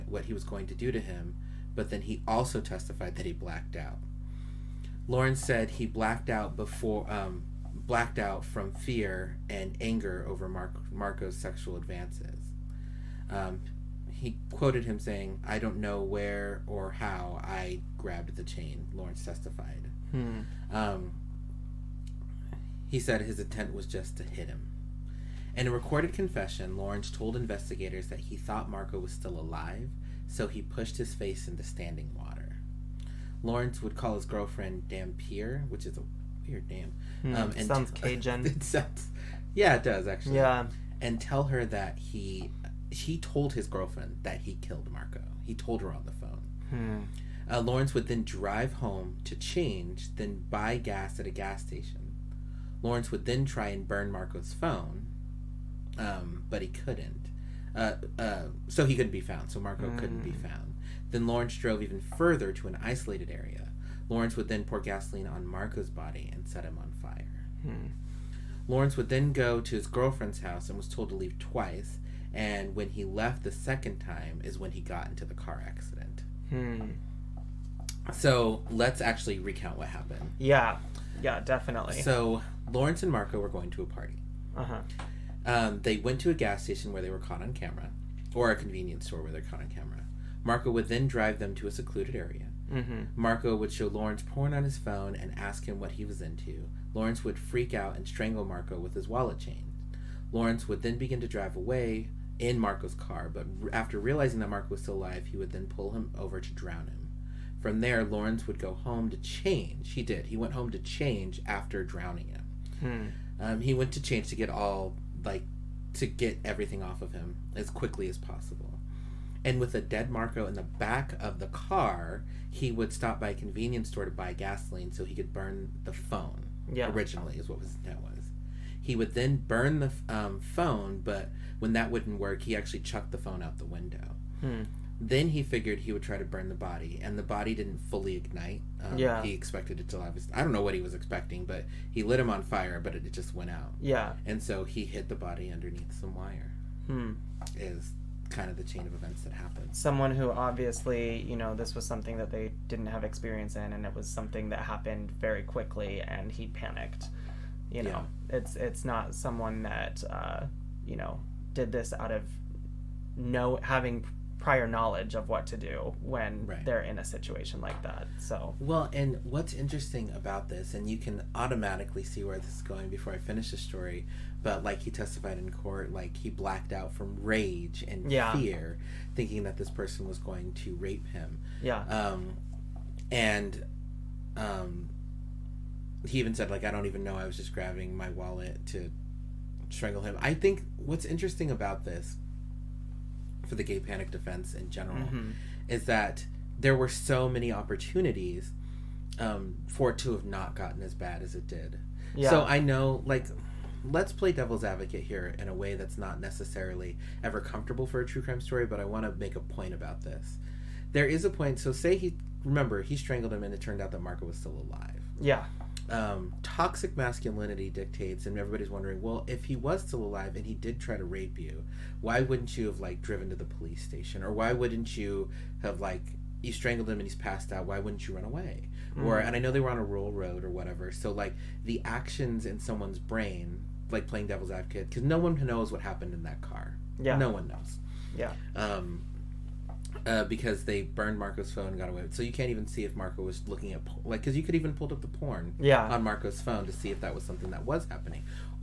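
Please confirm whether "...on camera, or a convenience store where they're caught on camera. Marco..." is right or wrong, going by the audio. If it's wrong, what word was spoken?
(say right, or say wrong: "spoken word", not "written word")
right.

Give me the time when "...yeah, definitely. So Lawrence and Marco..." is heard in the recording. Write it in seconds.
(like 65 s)
81 s.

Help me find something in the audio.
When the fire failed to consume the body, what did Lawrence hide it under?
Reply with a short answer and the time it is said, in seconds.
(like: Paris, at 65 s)
wire, at 146 s.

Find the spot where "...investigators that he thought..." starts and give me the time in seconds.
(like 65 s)
27 s.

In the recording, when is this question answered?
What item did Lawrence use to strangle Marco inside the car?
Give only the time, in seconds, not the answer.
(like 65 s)
99 s.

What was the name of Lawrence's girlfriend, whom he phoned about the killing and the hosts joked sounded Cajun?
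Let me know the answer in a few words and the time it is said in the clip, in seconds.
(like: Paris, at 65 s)
Dampier, at 34 s.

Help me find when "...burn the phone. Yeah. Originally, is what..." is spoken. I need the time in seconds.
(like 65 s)
125 s.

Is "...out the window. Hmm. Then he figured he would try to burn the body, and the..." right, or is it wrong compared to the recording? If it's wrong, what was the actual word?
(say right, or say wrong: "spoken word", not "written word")
right.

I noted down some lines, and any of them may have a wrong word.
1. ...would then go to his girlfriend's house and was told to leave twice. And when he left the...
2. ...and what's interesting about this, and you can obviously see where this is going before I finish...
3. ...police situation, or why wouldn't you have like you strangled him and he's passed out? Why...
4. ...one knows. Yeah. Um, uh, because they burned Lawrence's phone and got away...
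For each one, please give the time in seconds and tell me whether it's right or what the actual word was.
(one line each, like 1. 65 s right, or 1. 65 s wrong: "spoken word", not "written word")
1. 68 s right
2. 168 s wrong: "automatically", not "obviously"
3. 223 s wrong: "station", not "situation"
4. 237 s wrong: "Marco", not "Lawrence".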